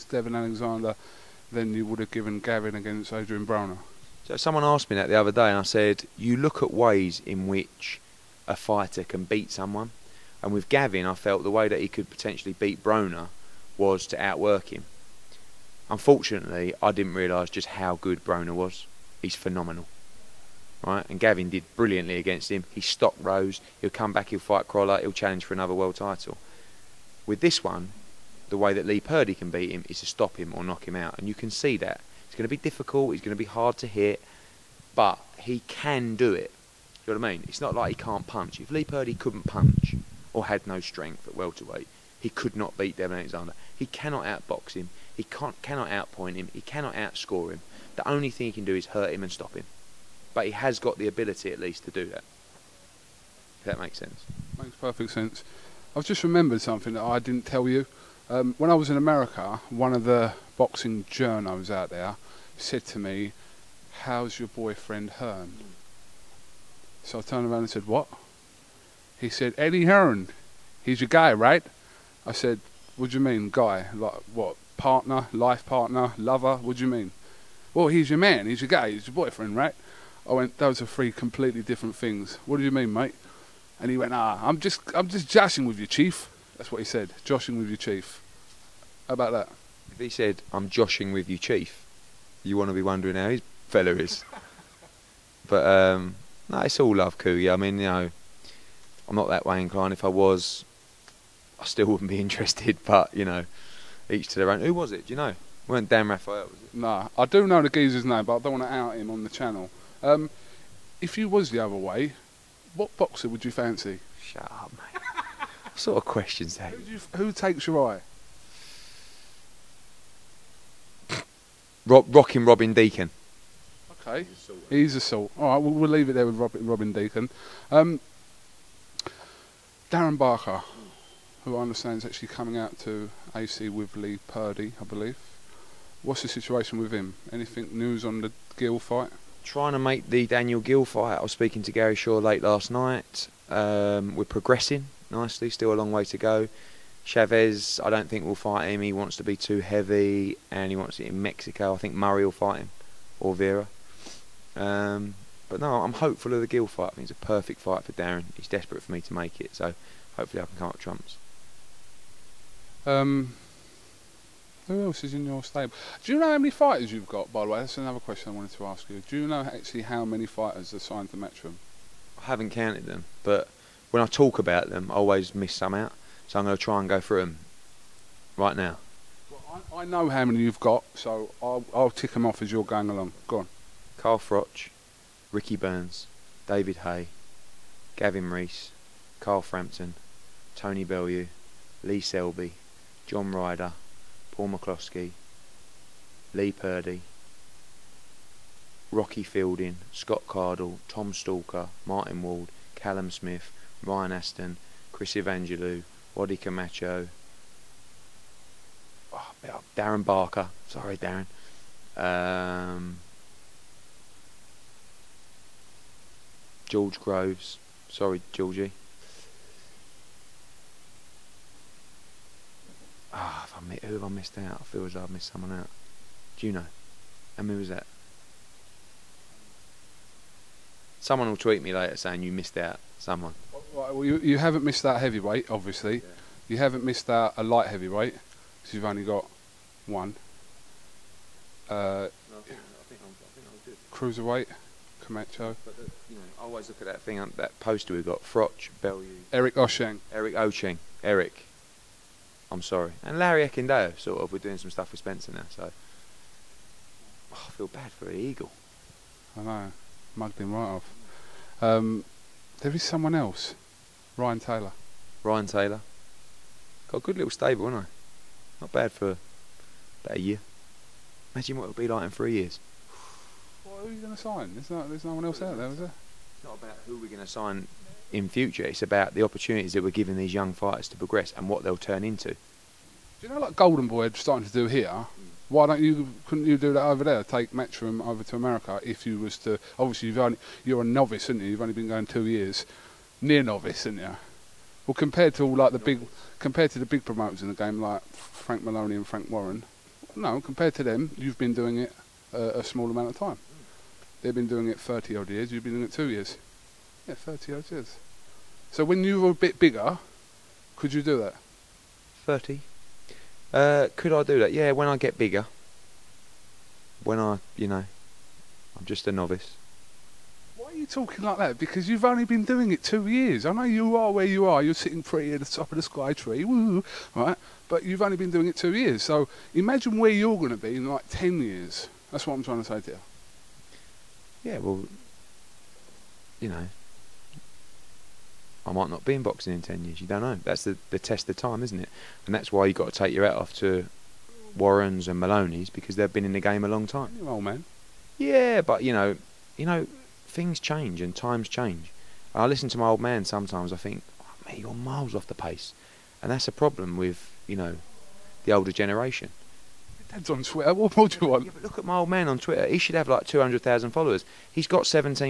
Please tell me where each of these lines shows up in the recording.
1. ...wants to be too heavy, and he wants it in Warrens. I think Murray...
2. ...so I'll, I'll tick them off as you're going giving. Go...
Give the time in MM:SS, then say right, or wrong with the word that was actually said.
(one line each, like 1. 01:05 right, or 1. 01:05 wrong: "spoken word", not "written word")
1. 02:28 wrong: "Mexico", not "Warrens"
2. 03:00 wrong: "along", not "giving".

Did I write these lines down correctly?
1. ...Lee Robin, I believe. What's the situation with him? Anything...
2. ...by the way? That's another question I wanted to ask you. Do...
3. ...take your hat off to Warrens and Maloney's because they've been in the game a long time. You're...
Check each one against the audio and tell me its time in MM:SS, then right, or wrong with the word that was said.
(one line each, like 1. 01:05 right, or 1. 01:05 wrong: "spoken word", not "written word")
1. 02:13 wrong: "Purdy", not "Robin"
2. 02:47 right
3. 05:42 right.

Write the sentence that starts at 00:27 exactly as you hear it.
With this one, the way that Lee Purdy can beat him is to stop him or knock him out.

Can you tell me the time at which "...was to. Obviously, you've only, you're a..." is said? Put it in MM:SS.
04:49.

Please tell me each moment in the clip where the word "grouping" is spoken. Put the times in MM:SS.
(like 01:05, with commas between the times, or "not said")
not said.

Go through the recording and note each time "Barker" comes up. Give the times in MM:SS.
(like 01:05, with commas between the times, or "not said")
02:10, 03:30.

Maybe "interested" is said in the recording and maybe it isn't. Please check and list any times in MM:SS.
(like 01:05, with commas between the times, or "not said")
01:42.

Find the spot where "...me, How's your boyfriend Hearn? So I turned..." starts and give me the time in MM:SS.
01:02.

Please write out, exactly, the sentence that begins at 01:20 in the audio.
I went, those are three completely different things.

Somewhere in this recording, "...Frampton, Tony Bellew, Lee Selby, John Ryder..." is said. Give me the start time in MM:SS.
03:09.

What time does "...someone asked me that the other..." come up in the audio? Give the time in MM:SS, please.
00:04.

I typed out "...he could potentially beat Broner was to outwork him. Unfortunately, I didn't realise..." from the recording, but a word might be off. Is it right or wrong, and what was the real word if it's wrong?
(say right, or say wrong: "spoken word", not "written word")
right.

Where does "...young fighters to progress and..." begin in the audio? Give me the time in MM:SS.
04:40.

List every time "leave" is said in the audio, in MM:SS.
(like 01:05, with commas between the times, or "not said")
02:05.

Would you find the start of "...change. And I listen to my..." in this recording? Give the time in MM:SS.
05:51.